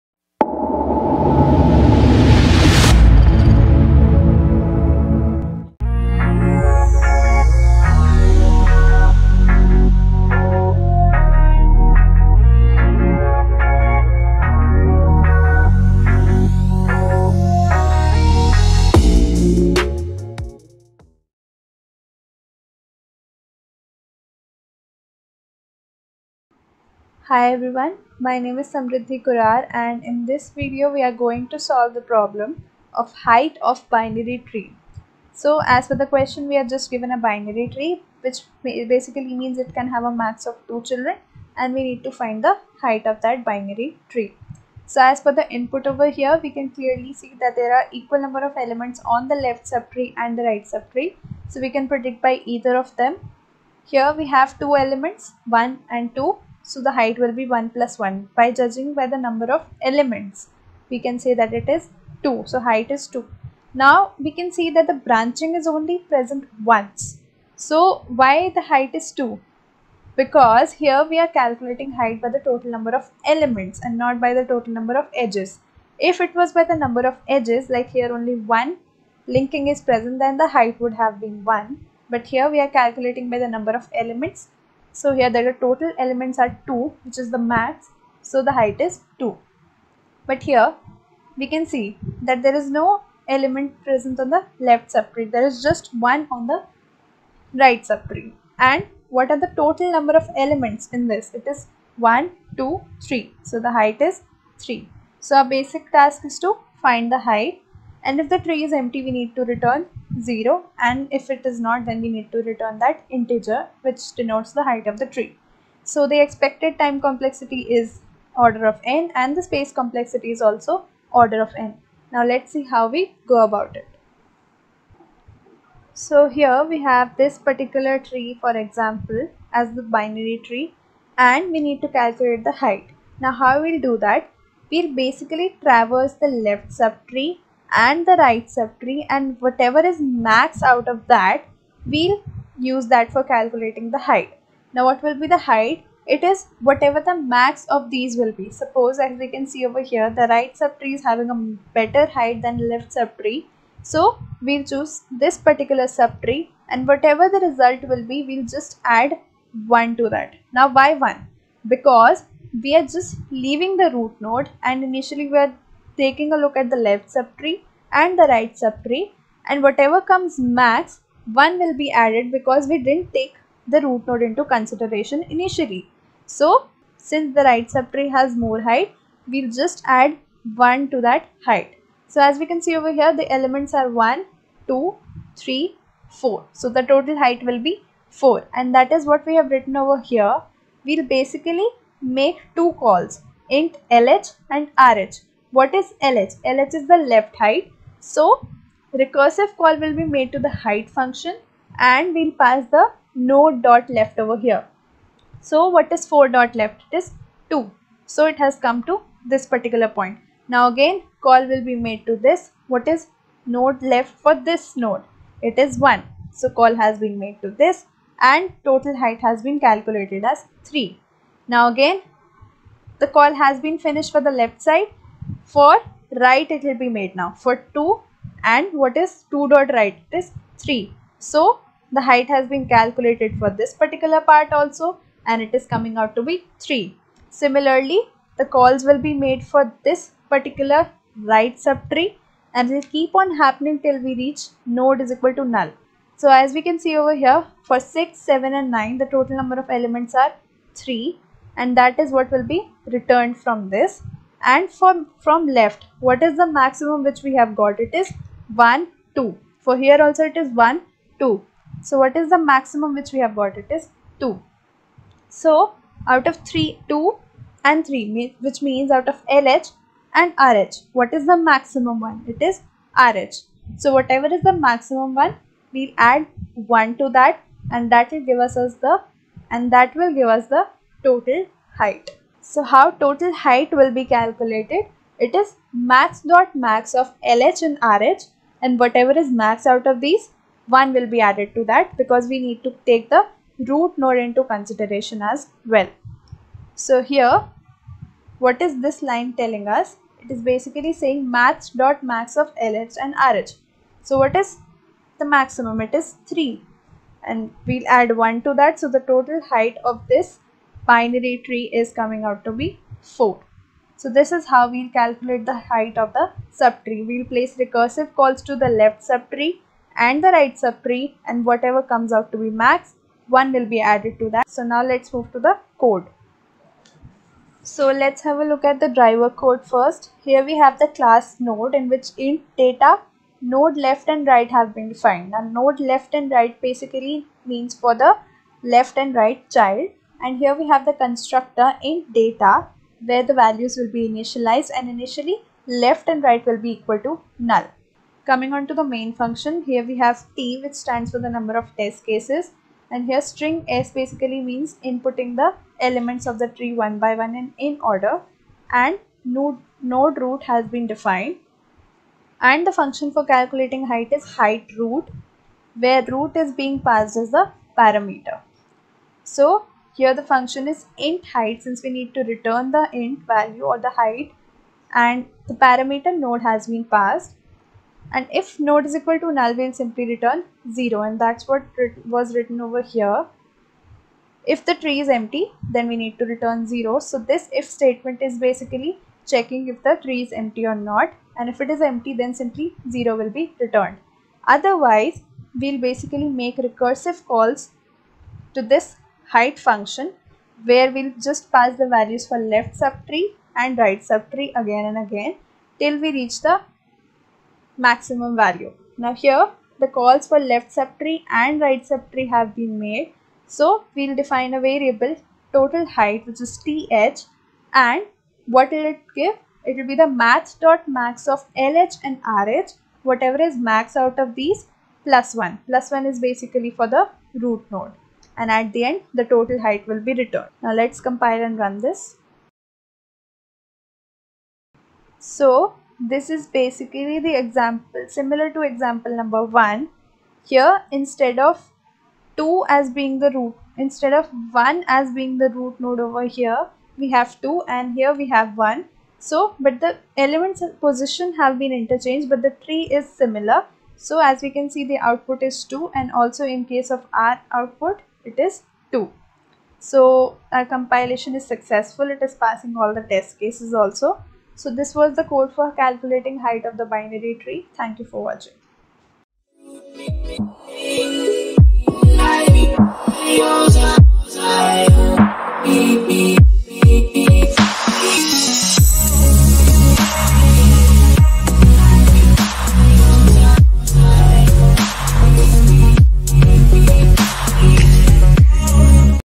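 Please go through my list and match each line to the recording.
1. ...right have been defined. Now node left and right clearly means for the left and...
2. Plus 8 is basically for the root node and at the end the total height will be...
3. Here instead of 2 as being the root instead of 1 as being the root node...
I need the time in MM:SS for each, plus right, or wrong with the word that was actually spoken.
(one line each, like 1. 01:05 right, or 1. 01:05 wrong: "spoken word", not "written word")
1. 05:34 wrong: "basically", not "clearly"
2. 07:05 wrong: "1", not "8"
3. 07:20 right.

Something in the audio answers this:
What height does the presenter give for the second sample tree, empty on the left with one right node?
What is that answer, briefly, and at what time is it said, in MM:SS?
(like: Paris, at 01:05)
3, at 01:43.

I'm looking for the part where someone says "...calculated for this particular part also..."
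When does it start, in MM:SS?
03:52.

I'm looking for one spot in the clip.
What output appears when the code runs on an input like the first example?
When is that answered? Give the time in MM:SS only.
07:34.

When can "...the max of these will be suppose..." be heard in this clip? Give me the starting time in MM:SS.
02:27.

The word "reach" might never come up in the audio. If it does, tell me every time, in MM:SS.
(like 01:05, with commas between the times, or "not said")
04:04, 06:46.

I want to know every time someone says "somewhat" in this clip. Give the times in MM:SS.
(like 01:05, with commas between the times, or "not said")
not said.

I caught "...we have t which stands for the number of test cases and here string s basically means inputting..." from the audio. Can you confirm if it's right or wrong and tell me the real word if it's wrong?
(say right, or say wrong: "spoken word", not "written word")
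right.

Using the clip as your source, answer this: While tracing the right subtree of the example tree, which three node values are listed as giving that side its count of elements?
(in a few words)
6, 7 and 9.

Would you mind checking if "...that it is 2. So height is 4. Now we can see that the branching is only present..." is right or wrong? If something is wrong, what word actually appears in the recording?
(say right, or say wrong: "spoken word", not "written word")
wrong: "2", not "4".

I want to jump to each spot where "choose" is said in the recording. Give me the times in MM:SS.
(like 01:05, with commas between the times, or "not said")
02:34.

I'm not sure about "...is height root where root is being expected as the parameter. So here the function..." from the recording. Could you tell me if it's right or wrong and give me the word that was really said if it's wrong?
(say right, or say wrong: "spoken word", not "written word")
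wrong: "passed", not "expected".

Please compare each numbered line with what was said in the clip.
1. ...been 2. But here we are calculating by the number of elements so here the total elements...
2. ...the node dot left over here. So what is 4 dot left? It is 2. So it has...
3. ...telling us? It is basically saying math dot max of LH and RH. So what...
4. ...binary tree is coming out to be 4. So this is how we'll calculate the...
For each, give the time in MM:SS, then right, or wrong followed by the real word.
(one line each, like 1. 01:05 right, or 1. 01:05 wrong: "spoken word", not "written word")
1. 01:21 wrong: "1", not "2"
2. 03:22 right
3. 04:59 right
4. 05:10 right.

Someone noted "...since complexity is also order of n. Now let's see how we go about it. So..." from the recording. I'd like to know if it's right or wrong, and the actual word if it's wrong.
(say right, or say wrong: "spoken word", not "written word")
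wrong: "space", not "since".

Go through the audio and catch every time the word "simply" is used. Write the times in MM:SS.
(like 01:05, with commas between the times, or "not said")
06:19, 06:32.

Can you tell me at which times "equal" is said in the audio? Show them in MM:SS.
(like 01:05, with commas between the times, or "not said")
00:47, 04:05, 05:46, 06:18.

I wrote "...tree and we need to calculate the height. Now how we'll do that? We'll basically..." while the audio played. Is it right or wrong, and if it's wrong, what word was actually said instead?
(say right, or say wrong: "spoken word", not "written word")
right.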